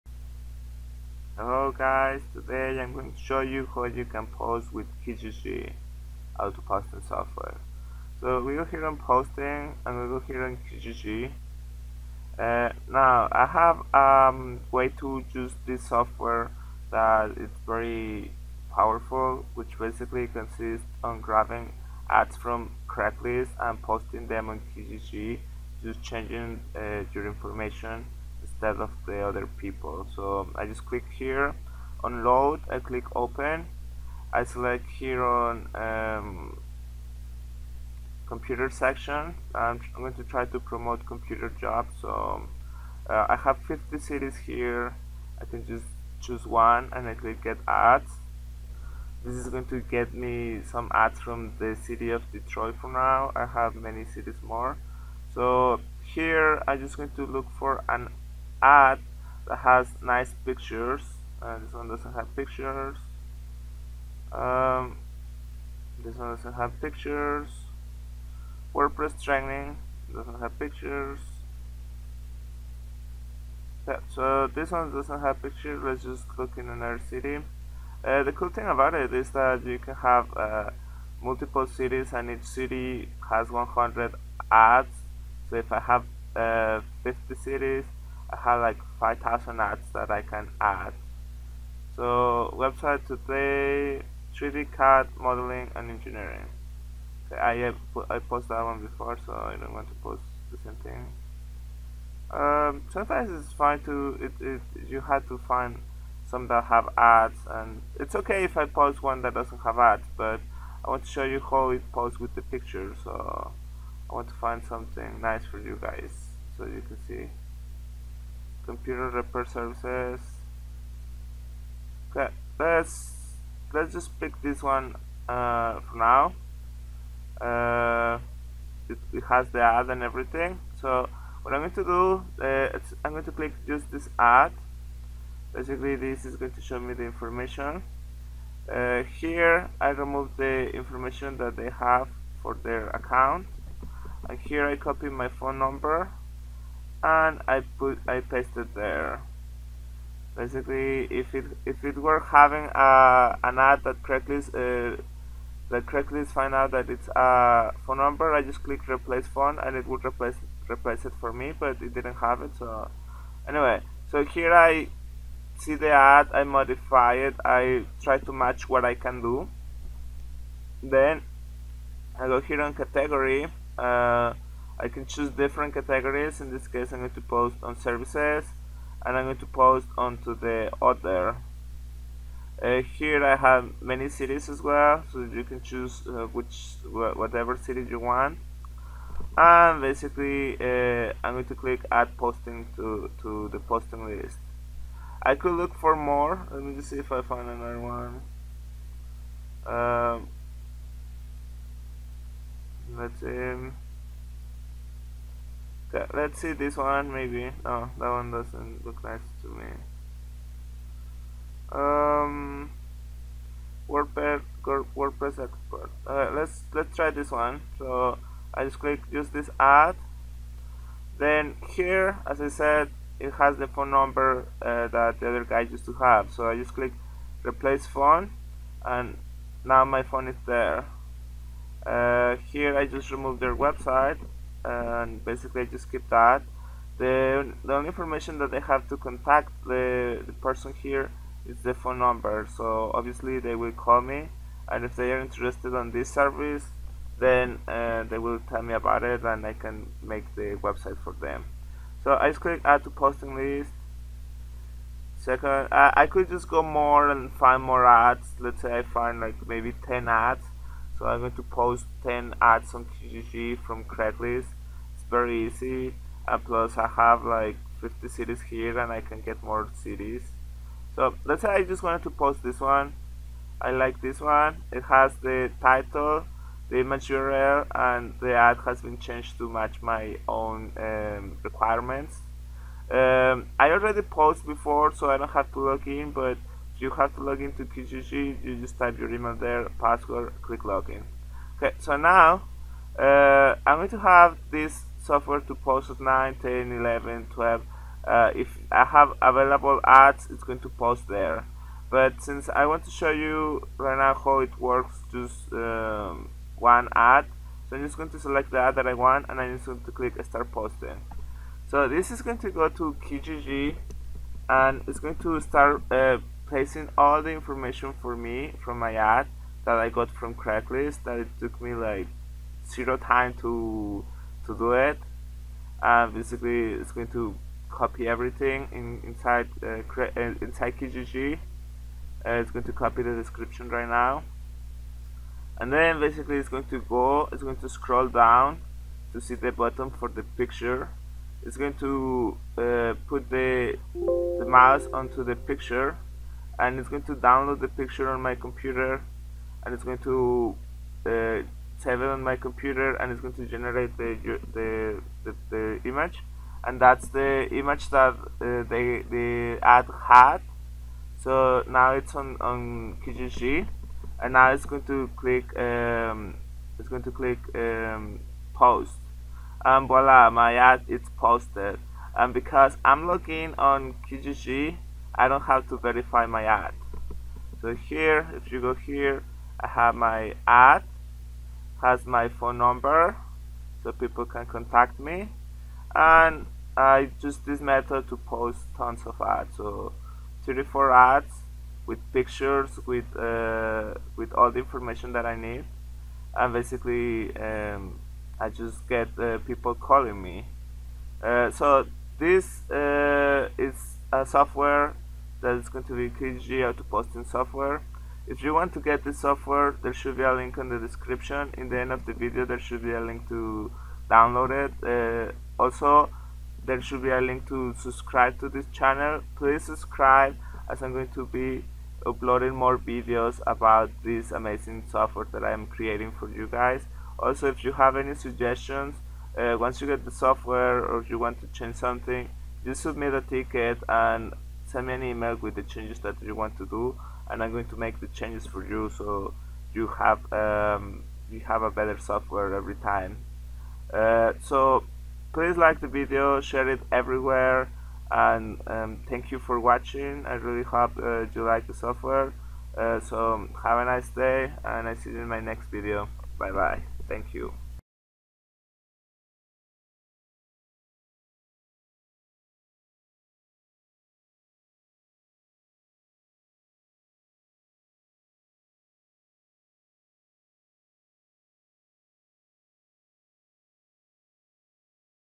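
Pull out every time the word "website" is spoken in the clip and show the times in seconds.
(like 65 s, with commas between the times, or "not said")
92 s, 233 s, 250 s.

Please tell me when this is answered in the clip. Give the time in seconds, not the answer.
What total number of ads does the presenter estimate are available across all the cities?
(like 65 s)
88 s.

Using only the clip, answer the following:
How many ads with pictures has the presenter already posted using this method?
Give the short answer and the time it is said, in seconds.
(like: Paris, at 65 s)
34, at 390 s.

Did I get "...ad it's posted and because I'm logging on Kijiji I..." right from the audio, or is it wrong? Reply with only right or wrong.
right.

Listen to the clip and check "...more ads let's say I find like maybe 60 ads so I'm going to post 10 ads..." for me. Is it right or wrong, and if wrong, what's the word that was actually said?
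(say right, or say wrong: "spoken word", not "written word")
wrong: "10", not "60".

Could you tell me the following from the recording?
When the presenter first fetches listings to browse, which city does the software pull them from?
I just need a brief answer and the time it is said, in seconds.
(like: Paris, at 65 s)
Detroit, at 52 s.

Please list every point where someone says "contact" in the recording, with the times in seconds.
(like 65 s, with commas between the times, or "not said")
238 s, 384 s.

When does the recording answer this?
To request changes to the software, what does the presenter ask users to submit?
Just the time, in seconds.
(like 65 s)
433 s.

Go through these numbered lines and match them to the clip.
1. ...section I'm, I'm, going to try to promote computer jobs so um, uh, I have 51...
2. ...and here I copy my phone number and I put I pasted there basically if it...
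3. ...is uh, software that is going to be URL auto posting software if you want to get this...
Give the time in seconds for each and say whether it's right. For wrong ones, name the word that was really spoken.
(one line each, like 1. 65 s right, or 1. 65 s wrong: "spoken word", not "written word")
1. 38 s wrong: "50", not "51"
2. 144 s right
3. 403 s wrong: "Kijiji", not "URL".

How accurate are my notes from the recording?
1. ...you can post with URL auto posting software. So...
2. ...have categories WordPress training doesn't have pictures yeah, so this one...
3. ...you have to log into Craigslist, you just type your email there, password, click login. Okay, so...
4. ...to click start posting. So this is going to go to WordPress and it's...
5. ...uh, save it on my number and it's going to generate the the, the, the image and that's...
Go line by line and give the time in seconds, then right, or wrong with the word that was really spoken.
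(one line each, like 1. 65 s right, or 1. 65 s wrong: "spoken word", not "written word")
1. 3 s wrong: "Kijiji", not "URL"
2. 66 s wrong: "pictures", not "categories"
3. 286 s wrong: "Kijiji", not "Craigslist"
4. 309 s wrong: "Kijiji", not "WordPress"
5. 351 s wrong: "computer", not "number".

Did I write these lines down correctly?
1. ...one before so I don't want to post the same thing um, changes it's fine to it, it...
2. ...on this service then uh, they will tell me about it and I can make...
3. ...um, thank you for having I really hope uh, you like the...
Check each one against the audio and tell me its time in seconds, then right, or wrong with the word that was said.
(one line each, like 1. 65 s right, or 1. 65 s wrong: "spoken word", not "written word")
1. 98 s wrong: "sometimes", not "changes"
2. 245 s right
3. 448 s wrong: "watching", not "having".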